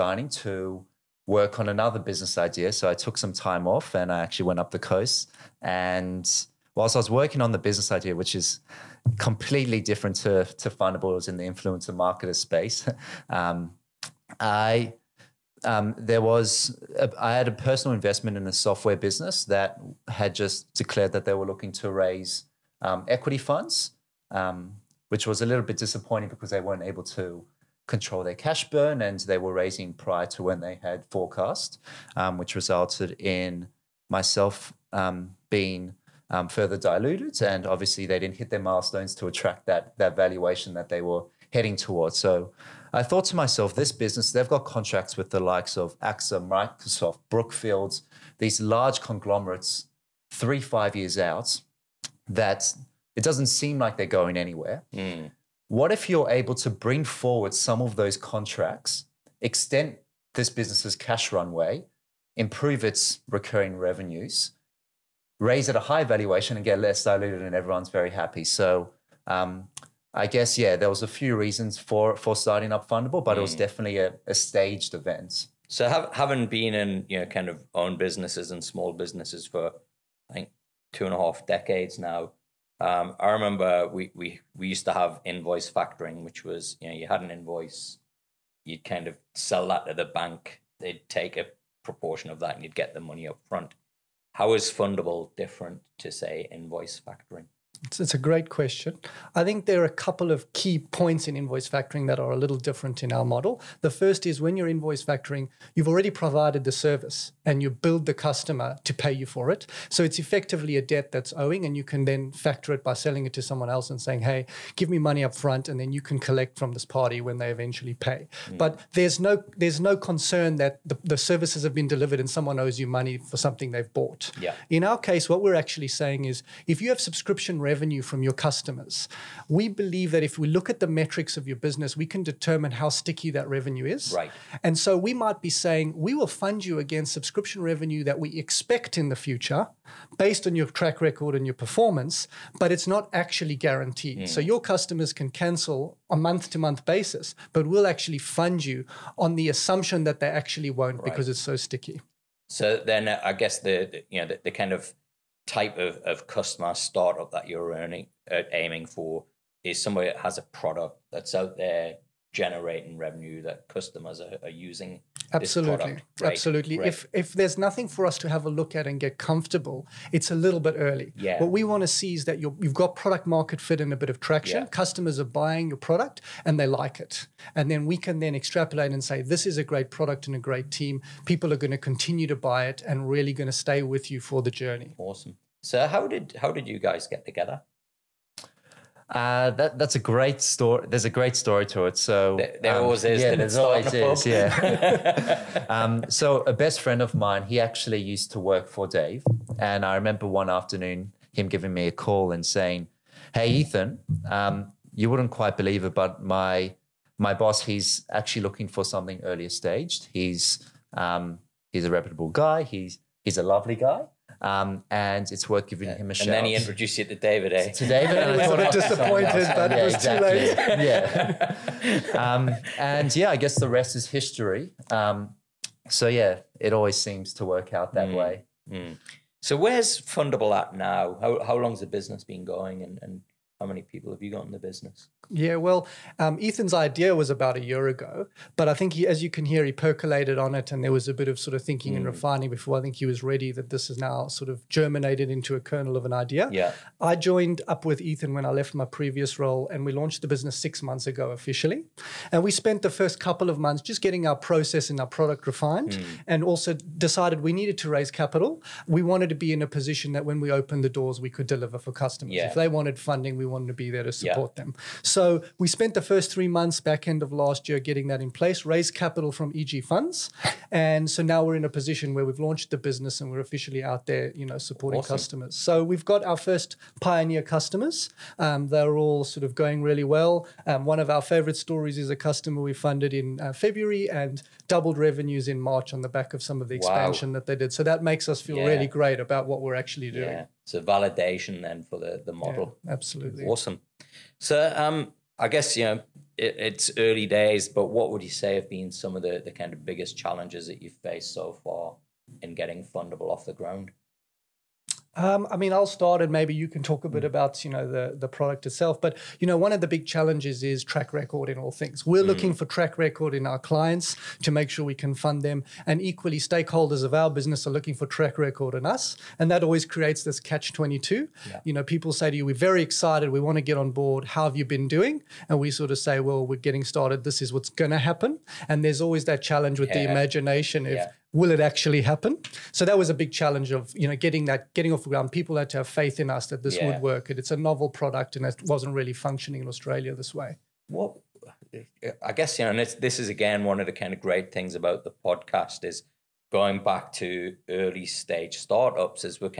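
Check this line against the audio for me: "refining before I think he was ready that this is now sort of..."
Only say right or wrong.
right.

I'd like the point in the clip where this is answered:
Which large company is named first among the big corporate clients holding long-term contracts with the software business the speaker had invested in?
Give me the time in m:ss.
0:45.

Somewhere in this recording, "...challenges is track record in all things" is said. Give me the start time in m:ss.
5:10.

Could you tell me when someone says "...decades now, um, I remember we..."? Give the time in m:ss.
1:21.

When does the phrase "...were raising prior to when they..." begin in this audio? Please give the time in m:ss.
0:29.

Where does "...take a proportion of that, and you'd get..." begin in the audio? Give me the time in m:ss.
1:31.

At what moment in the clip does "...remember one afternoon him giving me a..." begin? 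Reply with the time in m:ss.
3:19.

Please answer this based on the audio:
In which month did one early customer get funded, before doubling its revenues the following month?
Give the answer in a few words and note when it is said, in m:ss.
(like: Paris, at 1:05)
February, at 4:43.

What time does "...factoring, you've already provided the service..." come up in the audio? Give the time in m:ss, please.
1:45.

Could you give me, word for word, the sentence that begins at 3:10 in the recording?
There's a great story to it.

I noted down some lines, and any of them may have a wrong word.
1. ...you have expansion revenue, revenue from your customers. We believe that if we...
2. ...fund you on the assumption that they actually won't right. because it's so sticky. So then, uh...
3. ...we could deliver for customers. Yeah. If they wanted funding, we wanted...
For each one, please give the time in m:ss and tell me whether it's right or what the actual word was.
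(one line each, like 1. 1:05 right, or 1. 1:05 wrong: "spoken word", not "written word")
1. 2:06 wrong: "subscription", not "expansion"
2. 2:28 right
3. 4:21 right.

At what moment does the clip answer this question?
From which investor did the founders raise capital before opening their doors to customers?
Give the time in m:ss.
4:29.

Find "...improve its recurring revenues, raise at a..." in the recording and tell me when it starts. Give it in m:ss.
1:02.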